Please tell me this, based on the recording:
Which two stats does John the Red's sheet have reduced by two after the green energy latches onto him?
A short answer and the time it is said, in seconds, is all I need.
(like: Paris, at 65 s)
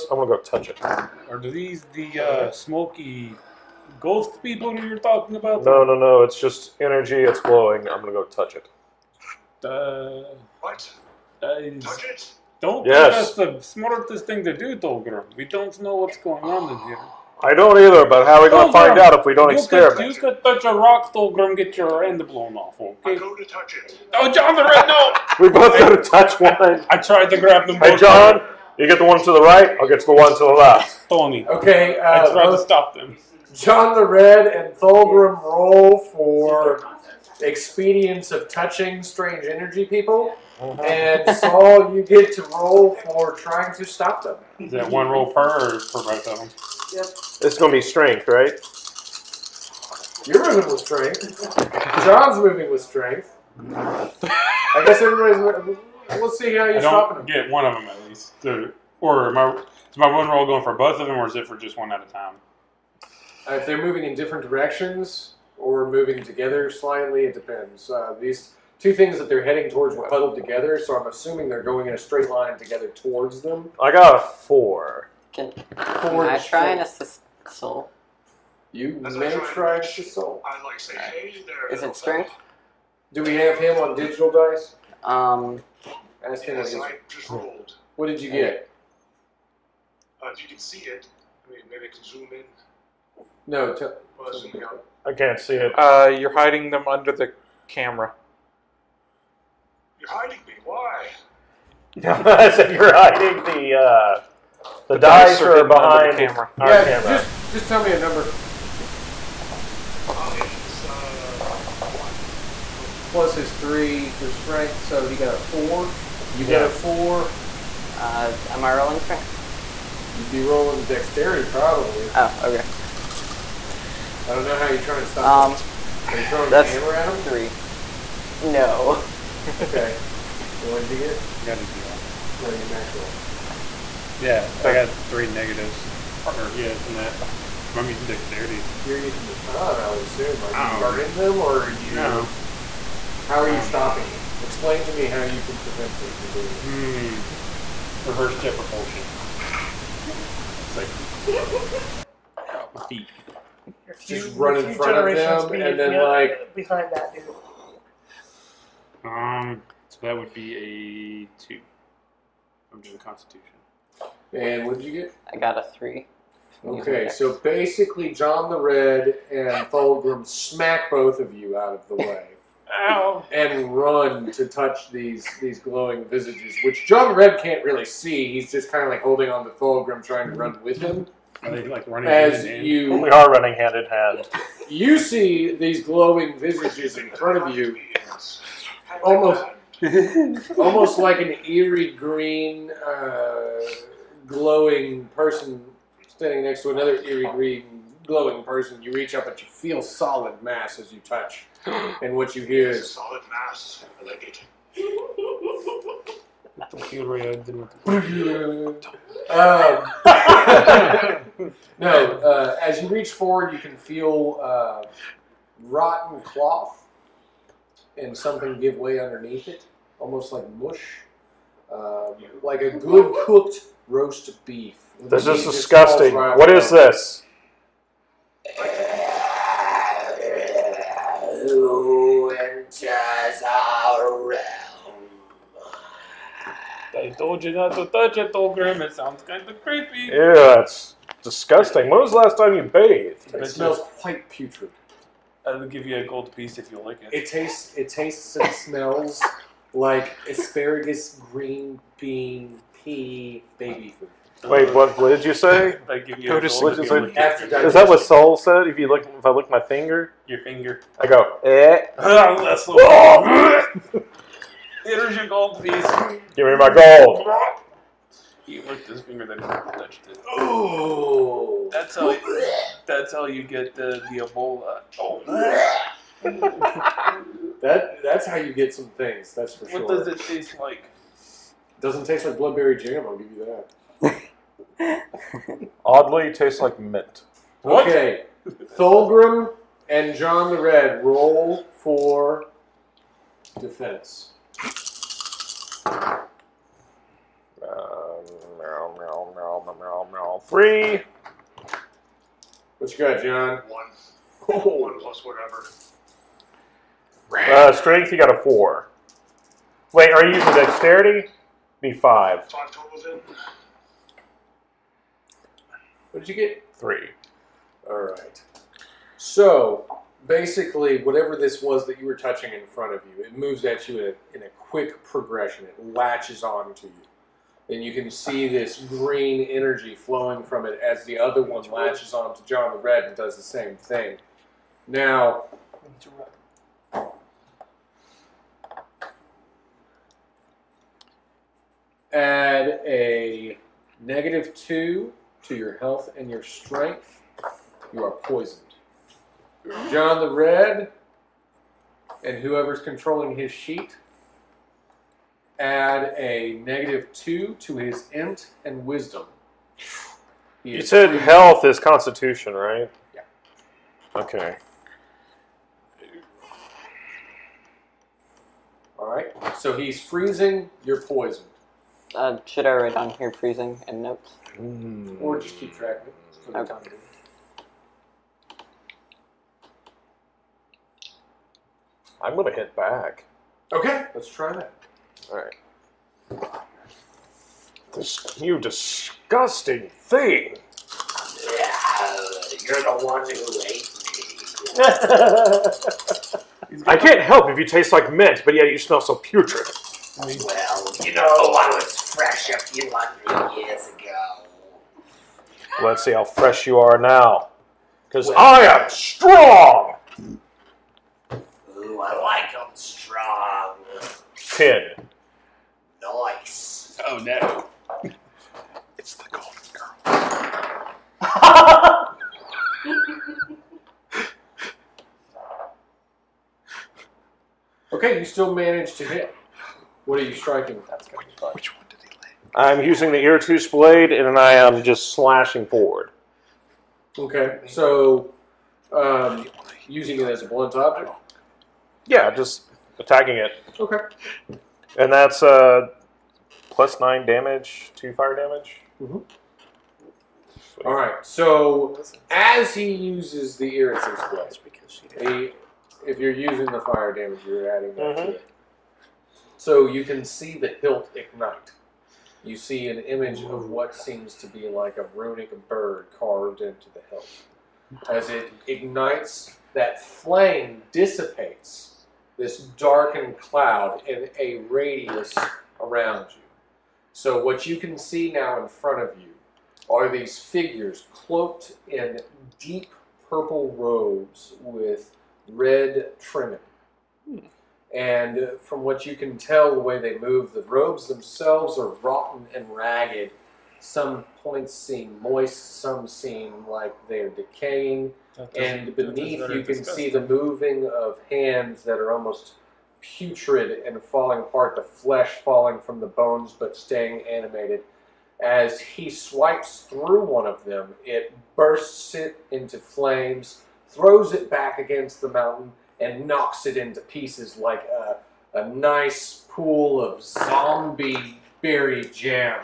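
int and wisdom, at 358 s.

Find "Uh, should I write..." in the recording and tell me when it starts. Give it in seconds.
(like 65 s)
372 s.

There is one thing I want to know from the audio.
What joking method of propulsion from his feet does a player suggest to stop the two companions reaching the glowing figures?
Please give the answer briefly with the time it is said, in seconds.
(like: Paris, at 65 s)
Reverse jet propulsion, at 148 s.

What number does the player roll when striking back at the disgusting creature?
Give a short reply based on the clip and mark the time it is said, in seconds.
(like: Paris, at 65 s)
10, at 414 s.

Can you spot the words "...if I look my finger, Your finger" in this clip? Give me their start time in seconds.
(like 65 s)
259 s.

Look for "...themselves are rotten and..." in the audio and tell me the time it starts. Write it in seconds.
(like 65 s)
491 s.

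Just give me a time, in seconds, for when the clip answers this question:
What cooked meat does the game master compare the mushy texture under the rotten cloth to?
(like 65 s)
223 s.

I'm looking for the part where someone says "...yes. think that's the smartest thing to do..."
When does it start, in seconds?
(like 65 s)
12 s.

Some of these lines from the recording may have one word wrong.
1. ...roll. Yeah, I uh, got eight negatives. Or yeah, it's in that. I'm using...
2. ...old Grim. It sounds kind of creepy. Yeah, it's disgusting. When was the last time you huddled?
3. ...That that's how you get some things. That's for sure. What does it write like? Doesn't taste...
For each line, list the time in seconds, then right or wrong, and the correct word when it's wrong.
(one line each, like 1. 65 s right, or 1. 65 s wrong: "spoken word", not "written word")
1. 132 s wrong: "three", not "eight"
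2. 238 s wrong: "bathed", not "huddled"
3. 277 s wrong: "taste", not "write".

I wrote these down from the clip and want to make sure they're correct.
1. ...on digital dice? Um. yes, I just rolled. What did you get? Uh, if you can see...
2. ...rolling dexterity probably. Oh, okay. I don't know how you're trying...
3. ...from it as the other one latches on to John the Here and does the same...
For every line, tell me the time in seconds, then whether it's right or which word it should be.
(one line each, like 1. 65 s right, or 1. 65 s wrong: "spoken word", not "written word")
1. 83 s right
2. 120 s right
3. 330 s wrong: "Red", not "Here".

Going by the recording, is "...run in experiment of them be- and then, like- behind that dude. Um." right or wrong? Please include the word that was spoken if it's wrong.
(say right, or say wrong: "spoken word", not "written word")
wrong: "front", not "experiment".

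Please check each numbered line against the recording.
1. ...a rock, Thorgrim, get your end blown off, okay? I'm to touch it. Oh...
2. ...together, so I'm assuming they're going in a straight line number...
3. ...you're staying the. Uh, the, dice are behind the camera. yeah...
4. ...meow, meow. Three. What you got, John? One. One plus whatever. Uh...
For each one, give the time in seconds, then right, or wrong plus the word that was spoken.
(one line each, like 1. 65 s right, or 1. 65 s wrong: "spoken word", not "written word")
1. 20 s right
2. 70 s wrong: "together", not "number"
3. 102 s wrong: "hiding", not "staying"
4. 299 s right.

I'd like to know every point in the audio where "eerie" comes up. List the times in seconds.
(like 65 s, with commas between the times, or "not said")
191 s, 197 s.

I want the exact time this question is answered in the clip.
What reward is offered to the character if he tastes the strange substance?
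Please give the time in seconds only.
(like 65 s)
245 s.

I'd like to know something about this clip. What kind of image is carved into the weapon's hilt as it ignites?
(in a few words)
runic bird.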